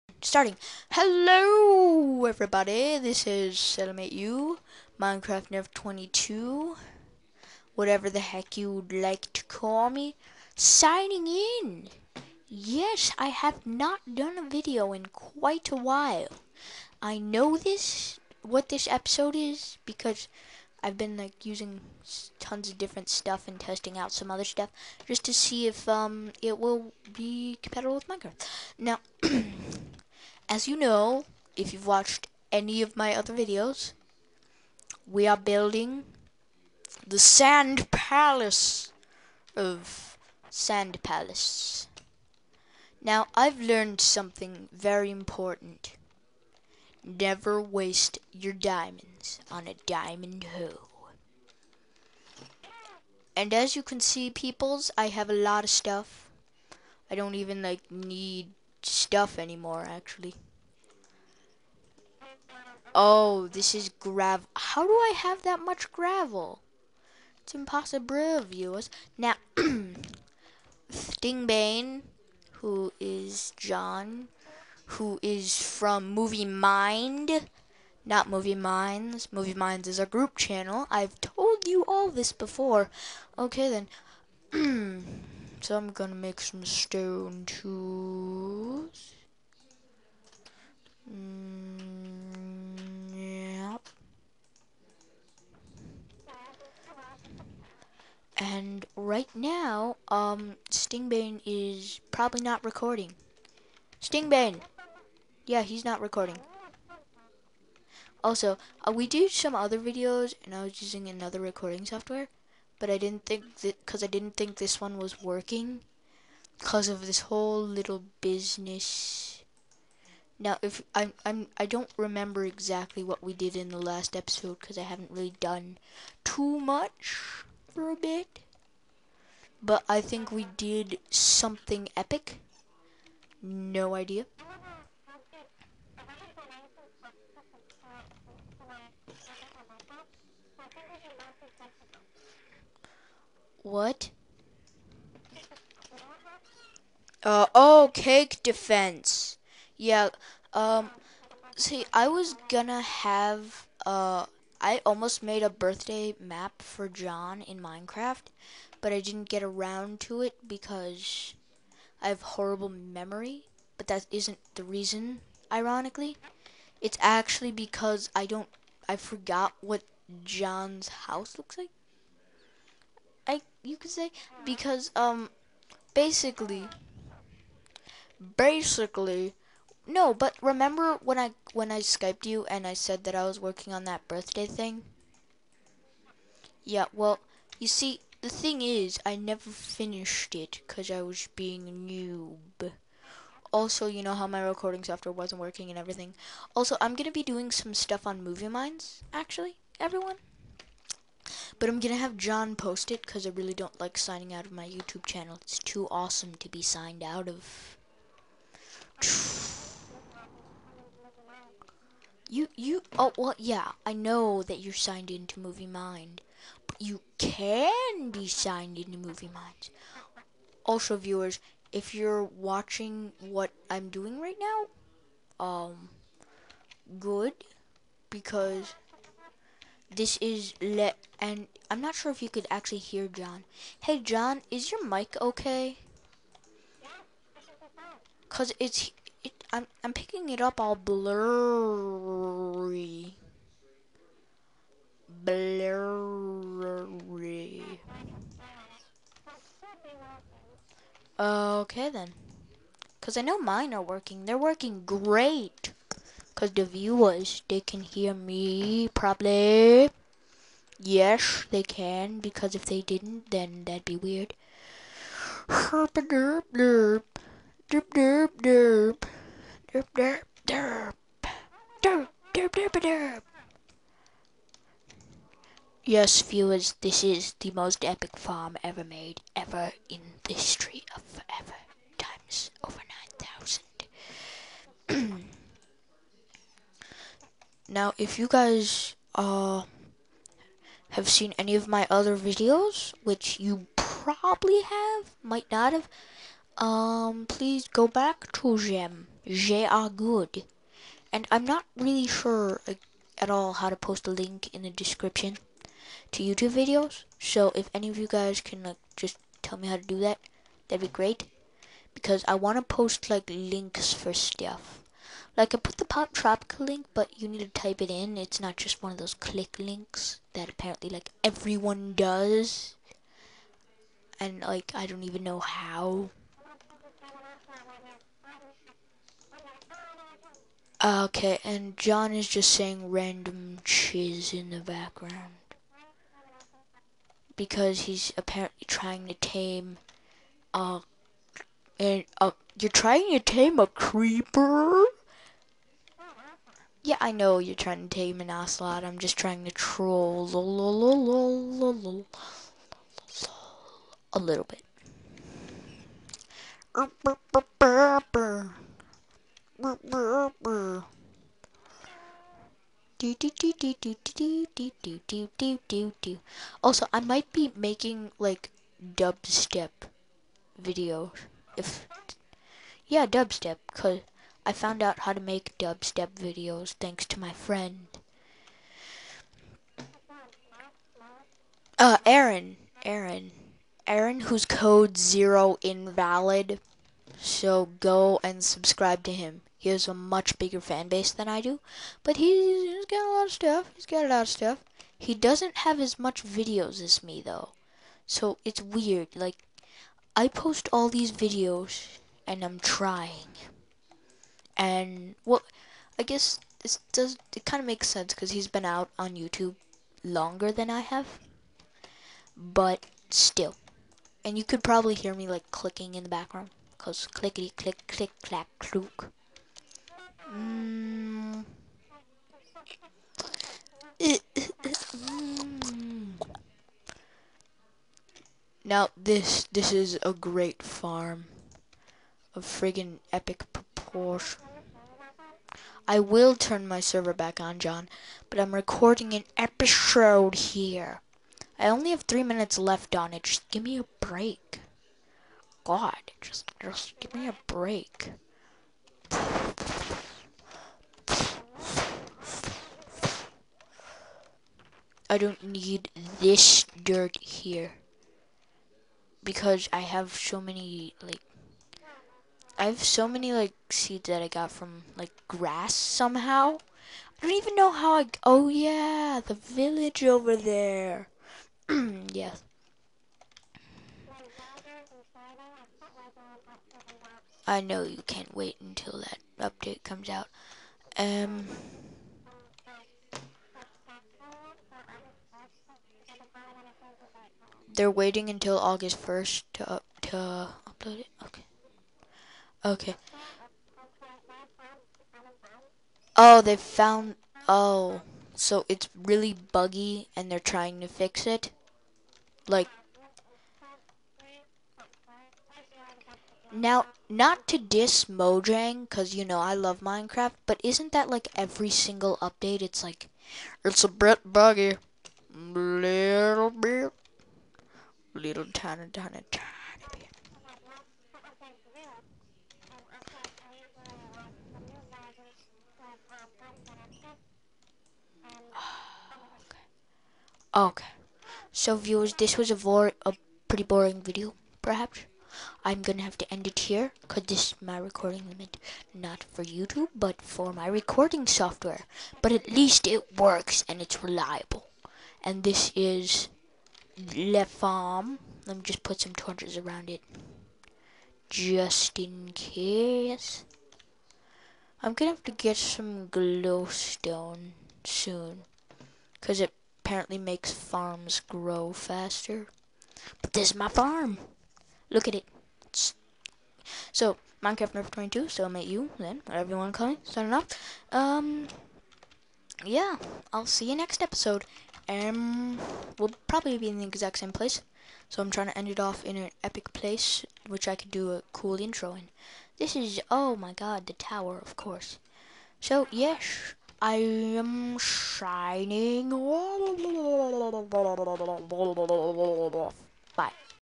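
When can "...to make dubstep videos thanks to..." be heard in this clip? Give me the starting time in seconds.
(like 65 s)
375 s.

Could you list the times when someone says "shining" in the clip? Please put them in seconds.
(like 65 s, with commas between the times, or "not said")
587 s.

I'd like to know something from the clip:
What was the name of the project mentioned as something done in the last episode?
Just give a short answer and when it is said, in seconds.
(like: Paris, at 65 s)
cake defense, at 147 s.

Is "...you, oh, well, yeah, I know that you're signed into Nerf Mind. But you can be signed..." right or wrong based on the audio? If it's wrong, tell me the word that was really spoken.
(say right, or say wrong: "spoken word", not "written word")
wrong: "Movie", not "Nerf".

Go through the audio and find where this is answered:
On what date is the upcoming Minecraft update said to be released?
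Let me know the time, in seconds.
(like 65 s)
488 s.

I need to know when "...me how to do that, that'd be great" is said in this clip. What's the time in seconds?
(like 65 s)
309 s.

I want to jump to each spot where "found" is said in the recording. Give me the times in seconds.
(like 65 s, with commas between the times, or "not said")
374 s, 496 s.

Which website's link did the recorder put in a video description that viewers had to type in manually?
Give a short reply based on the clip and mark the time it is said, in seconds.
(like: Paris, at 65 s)
Poptropica, at 315 s.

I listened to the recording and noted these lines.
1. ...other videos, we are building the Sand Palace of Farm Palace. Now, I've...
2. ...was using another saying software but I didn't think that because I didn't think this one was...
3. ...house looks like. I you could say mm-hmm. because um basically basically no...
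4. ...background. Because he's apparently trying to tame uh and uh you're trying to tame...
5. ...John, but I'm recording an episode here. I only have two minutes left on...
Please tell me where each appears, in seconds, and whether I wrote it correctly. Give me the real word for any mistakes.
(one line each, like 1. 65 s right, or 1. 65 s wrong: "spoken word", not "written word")
1. 33 s wrong: "Sand", not "Farm"
2. 110 s wrong: "recording", not "saying"
3. 171 s right
4. 334 s right
5. 437 s wrong: "three", not "two".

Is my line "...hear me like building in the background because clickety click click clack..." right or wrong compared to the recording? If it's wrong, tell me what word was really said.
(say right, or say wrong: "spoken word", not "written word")
wrong: "clicking", not "building".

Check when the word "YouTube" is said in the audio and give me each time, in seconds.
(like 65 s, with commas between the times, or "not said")
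204 s, 306 s, 409 s, 539 s.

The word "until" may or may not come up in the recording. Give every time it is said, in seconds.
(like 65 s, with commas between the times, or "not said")
478 s, 488 s.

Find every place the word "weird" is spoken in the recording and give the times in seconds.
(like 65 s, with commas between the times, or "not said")
263 s, 398 s.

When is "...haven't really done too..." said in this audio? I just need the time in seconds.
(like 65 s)
124 s.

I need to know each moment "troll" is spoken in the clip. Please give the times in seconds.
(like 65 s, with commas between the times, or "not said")
349 s.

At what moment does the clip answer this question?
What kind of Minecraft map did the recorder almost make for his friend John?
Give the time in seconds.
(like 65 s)
155 s.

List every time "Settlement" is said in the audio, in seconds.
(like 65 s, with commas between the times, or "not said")
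3 s.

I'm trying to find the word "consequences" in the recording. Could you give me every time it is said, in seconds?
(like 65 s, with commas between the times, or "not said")
not said.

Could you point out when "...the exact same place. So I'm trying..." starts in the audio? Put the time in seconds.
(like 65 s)
576 s.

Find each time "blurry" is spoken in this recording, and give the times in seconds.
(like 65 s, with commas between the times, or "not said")
240 s, 245 s.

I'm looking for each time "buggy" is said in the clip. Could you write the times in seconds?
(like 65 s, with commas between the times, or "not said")
499 s, 514 s.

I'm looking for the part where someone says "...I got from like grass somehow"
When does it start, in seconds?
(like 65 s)
464 s.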